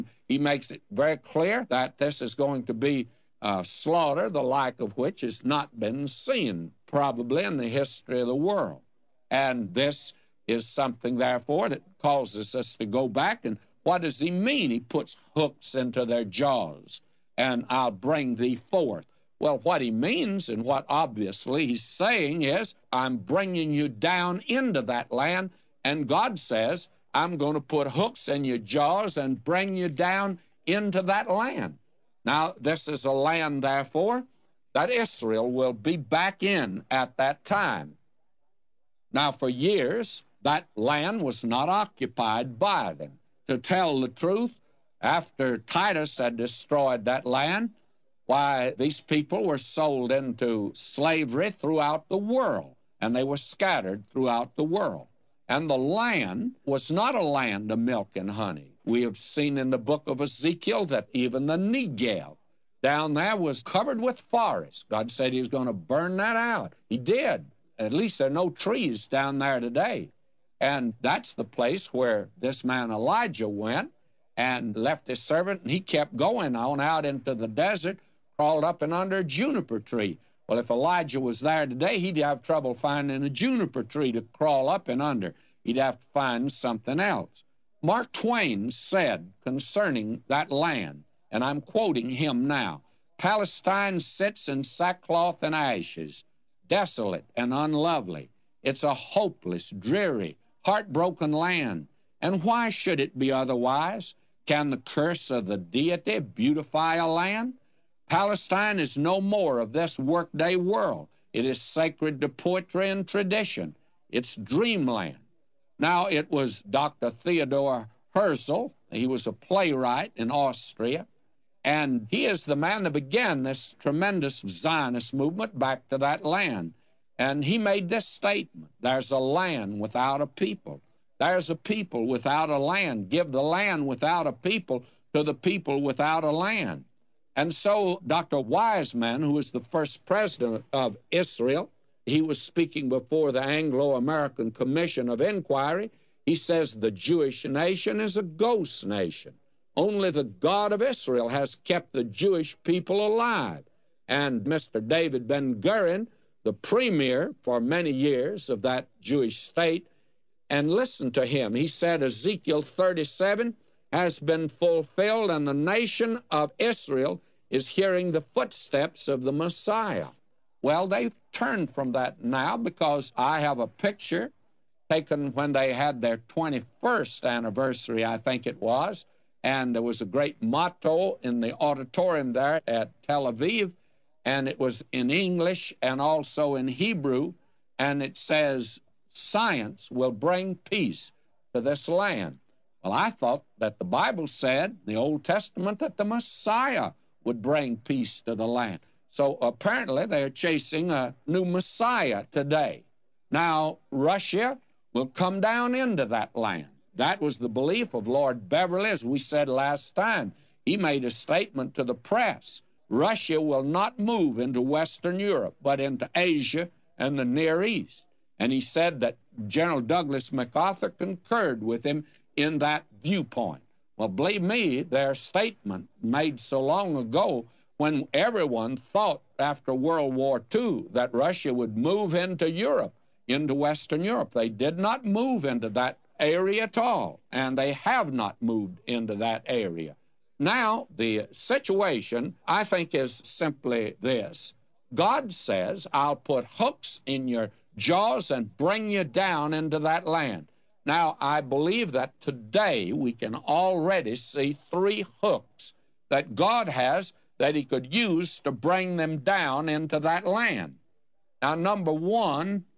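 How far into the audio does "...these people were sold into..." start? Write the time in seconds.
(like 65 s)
48 s.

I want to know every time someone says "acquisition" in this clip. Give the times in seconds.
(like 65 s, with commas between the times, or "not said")
not said.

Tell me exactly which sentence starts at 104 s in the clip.
Can the curse of the deity beautify a land?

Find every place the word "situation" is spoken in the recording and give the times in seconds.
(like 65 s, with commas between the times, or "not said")
241 s.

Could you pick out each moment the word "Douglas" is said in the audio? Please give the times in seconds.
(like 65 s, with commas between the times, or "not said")
219 s.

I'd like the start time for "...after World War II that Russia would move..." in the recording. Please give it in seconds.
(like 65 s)
229 s.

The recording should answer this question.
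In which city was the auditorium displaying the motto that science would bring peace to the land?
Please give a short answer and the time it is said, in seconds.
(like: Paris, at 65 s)
Tel Aviv, at 183 s.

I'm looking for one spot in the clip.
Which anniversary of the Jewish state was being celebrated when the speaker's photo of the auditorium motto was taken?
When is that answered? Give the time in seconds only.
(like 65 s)
176 s.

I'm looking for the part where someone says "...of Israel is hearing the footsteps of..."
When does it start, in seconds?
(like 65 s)
166 s.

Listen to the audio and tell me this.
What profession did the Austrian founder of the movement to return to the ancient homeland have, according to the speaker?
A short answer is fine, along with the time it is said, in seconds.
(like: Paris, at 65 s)
playwright, at 119 s.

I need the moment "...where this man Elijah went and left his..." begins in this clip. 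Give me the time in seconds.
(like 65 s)
71 s.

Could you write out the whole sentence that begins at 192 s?
Well, I thought that the Bible said, the Old Testament, that the Messiah would bring peace to the land.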